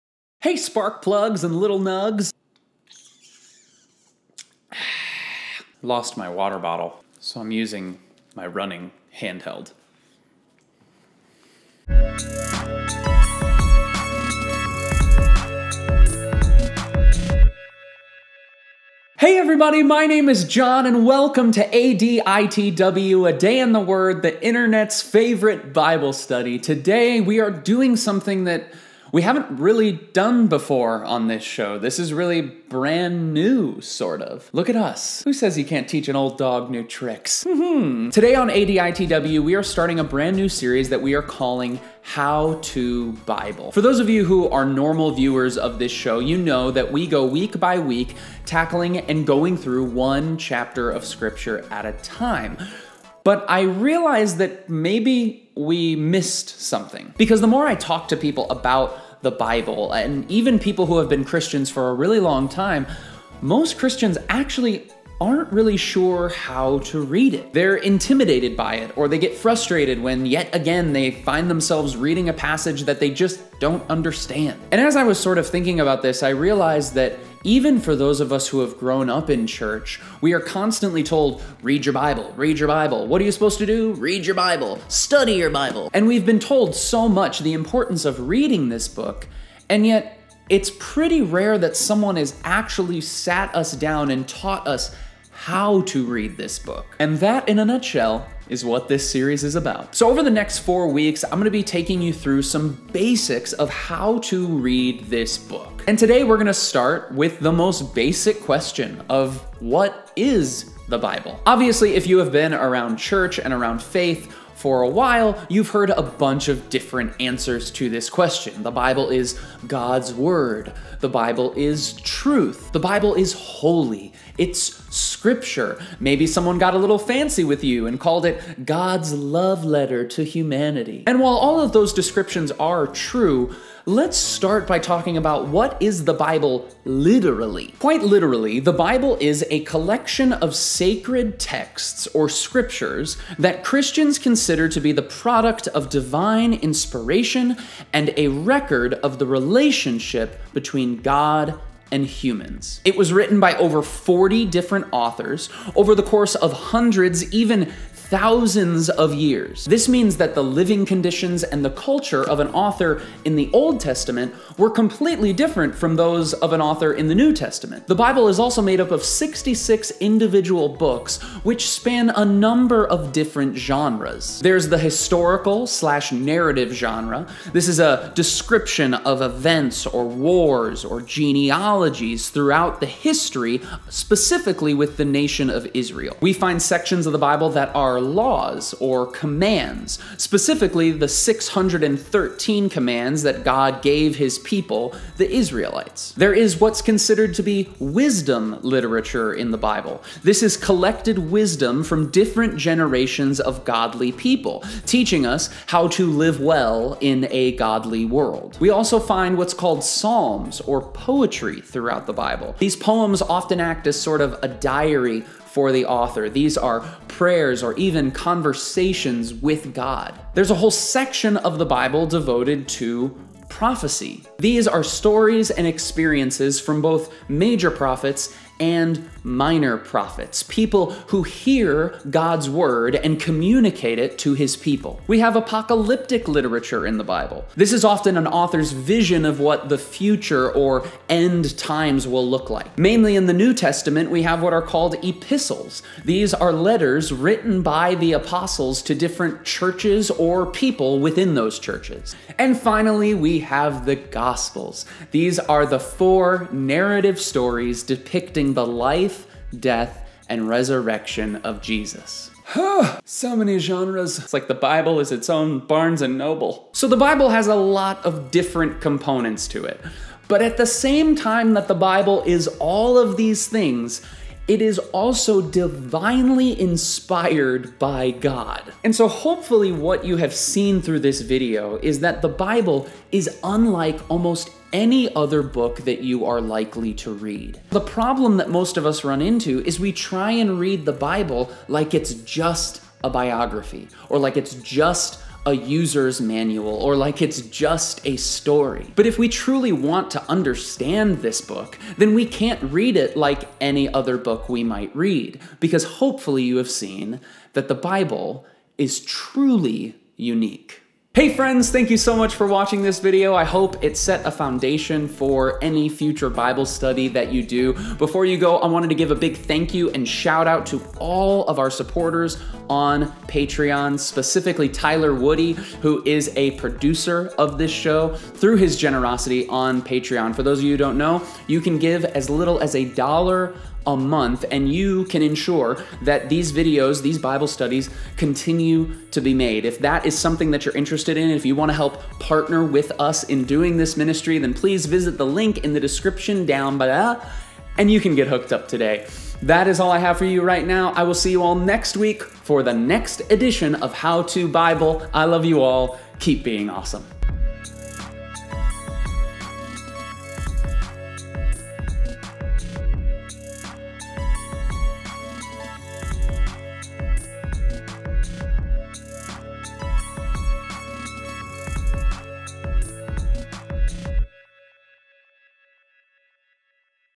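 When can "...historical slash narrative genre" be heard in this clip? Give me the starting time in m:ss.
2:54.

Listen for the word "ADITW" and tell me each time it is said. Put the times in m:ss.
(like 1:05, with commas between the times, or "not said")
0:21, 0:38.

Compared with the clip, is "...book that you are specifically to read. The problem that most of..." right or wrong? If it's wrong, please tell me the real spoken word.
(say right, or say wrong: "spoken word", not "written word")
wrong: "likely", not "specifically".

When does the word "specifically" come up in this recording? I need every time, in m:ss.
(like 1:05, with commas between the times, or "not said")
3:03, 3:10, 5:23.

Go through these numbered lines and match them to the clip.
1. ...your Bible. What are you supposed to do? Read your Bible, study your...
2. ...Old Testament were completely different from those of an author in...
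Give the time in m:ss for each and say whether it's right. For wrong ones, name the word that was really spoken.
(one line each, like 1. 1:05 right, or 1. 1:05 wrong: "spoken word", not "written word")
1. 1:22 right
2. 2:43 right.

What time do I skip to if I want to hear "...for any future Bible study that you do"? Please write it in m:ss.
5:15.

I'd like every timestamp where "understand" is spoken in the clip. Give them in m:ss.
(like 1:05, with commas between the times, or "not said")
1:13, 5:00.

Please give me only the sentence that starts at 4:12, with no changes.
And finally, we have the Gospels.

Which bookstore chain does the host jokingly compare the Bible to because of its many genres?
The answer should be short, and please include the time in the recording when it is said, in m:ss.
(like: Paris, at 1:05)
Barnes and Noble, at 4:25.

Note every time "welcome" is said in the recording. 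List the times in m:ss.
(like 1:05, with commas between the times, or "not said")
0:21.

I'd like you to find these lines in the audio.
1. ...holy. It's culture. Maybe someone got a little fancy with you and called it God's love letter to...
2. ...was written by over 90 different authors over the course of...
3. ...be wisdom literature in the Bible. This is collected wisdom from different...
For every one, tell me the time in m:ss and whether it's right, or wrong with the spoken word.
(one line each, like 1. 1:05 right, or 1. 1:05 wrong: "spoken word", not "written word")
1. 2:03 wrong: "scripture", not "culture"
2. 2:32 wrong: "40", not "90"
3. 3:17 right.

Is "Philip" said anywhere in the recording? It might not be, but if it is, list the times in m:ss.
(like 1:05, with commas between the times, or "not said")
not said.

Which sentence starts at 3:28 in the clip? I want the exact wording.
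We also find what's called psalms or poetry throughout the Bible.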